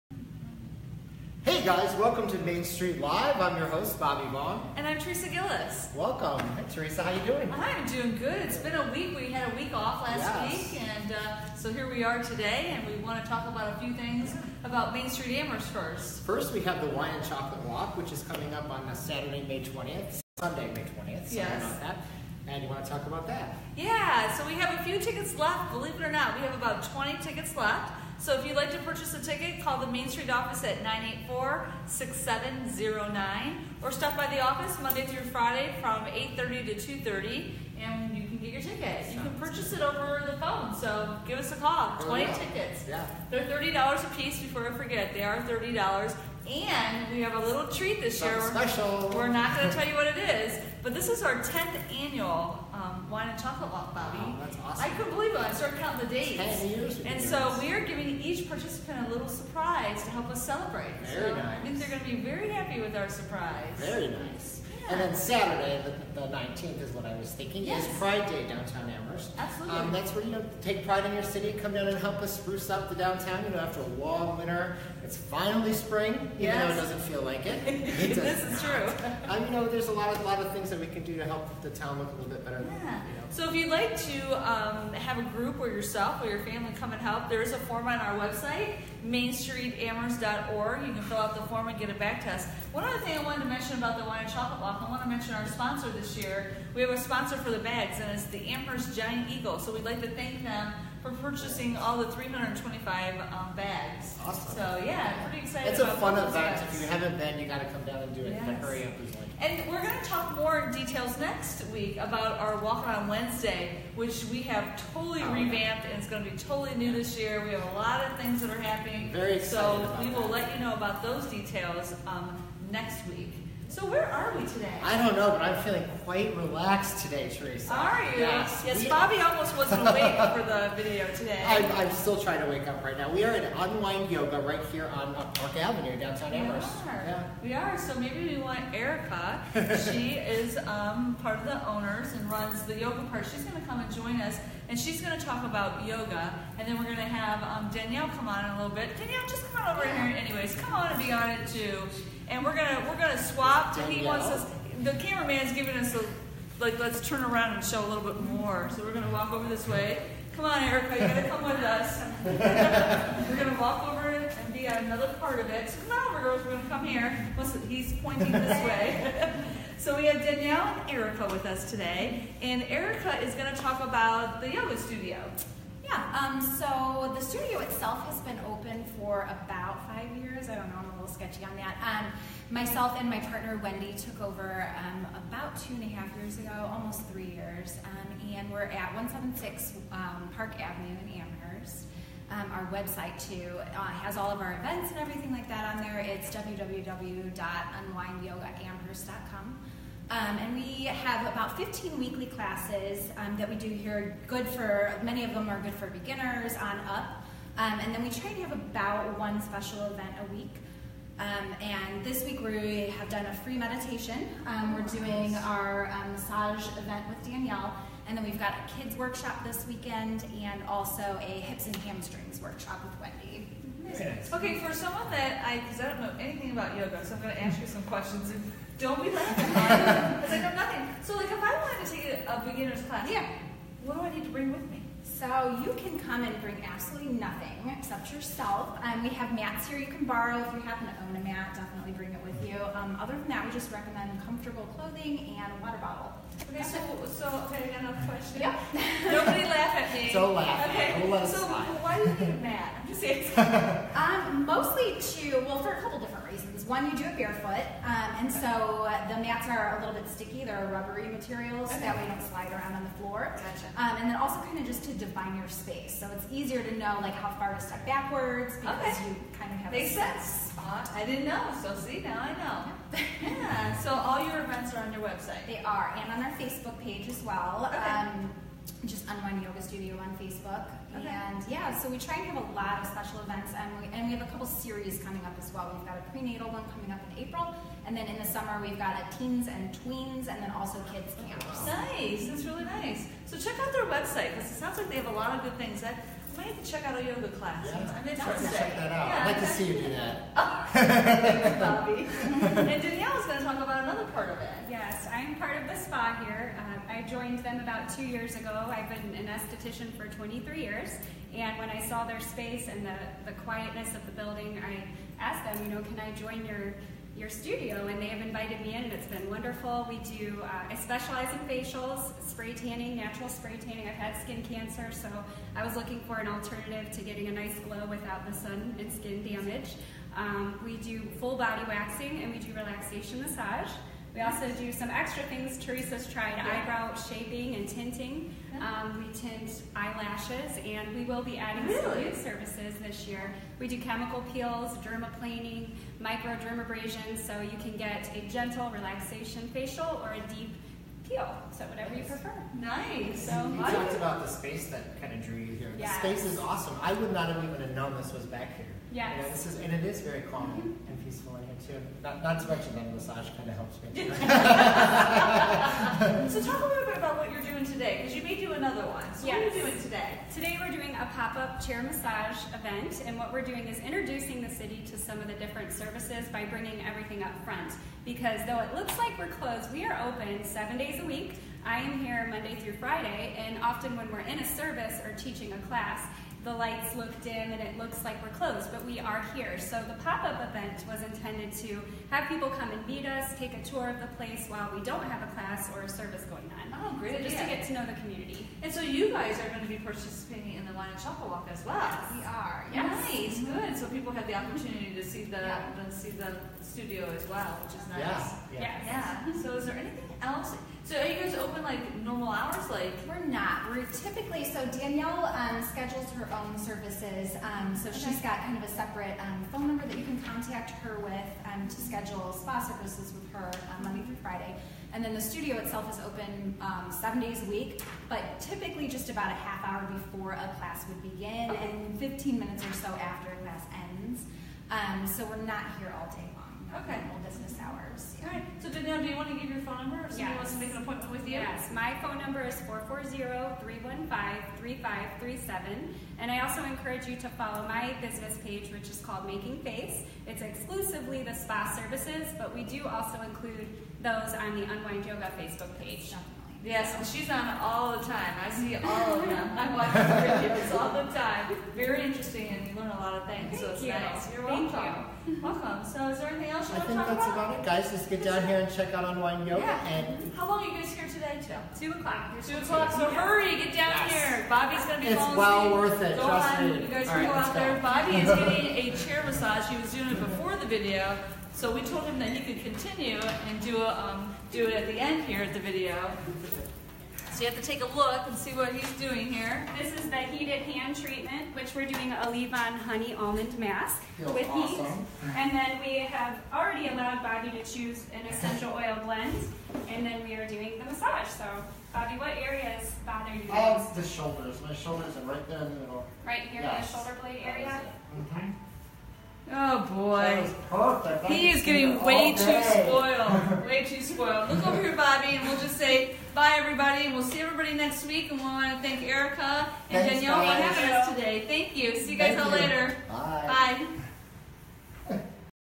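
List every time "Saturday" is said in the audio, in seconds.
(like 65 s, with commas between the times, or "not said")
18 s, 65 s.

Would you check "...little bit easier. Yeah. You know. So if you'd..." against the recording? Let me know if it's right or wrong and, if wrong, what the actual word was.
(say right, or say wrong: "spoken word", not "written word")
wrong: "better", not "easier".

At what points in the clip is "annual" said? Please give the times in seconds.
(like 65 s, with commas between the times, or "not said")
52 s.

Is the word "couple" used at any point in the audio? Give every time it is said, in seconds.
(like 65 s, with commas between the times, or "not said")
255 s, 284 s.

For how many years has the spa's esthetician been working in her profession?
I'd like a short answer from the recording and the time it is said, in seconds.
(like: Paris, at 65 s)
23, at 310 s.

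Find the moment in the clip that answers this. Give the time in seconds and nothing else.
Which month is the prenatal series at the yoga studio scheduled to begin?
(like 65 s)
286 s.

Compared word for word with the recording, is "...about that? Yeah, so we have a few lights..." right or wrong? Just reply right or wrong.
wrong.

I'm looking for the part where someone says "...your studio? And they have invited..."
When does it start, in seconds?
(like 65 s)
317 s.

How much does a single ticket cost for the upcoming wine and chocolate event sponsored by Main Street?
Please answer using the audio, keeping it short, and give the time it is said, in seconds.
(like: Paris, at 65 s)
$30, at 43 s.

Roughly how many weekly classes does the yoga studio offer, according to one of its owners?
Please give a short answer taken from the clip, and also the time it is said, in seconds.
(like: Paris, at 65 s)
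15, at 201 s.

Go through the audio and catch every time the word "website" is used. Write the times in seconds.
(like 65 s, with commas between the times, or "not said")
88 s, 192 s, 275 s, 293 s.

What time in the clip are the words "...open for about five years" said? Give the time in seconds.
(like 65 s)
178 s.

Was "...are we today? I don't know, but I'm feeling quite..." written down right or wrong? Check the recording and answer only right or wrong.
right.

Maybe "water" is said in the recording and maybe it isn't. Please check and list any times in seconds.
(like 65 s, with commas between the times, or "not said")
245 s.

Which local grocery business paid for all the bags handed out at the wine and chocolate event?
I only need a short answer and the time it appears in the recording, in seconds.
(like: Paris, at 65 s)
Amherst Giant Eagle, at 98 s.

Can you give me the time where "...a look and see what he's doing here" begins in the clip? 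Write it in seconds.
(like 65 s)
487 s.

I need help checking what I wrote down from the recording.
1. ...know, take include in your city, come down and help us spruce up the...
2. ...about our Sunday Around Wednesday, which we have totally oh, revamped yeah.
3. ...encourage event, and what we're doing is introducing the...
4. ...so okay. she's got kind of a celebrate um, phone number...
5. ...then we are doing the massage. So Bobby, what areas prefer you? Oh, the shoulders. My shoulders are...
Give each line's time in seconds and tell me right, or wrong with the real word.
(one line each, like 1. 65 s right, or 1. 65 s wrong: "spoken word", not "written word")
1. 70 s wrong: "pride", not "include"
2. 111 s wrong: "Walk", not "Sunday"
3. 371 s wrong: "massage", not "encourage"
4. 417 s wrong: "separate", not "celebrate"
5. 500 s wrong: "bother", not "prefer".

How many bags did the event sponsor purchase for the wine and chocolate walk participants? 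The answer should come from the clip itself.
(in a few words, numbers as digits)
325.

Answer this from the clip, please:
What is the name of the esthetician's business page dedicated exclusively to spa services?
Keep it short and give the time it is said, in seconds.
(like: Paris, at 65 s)
Making Face, at 449 s.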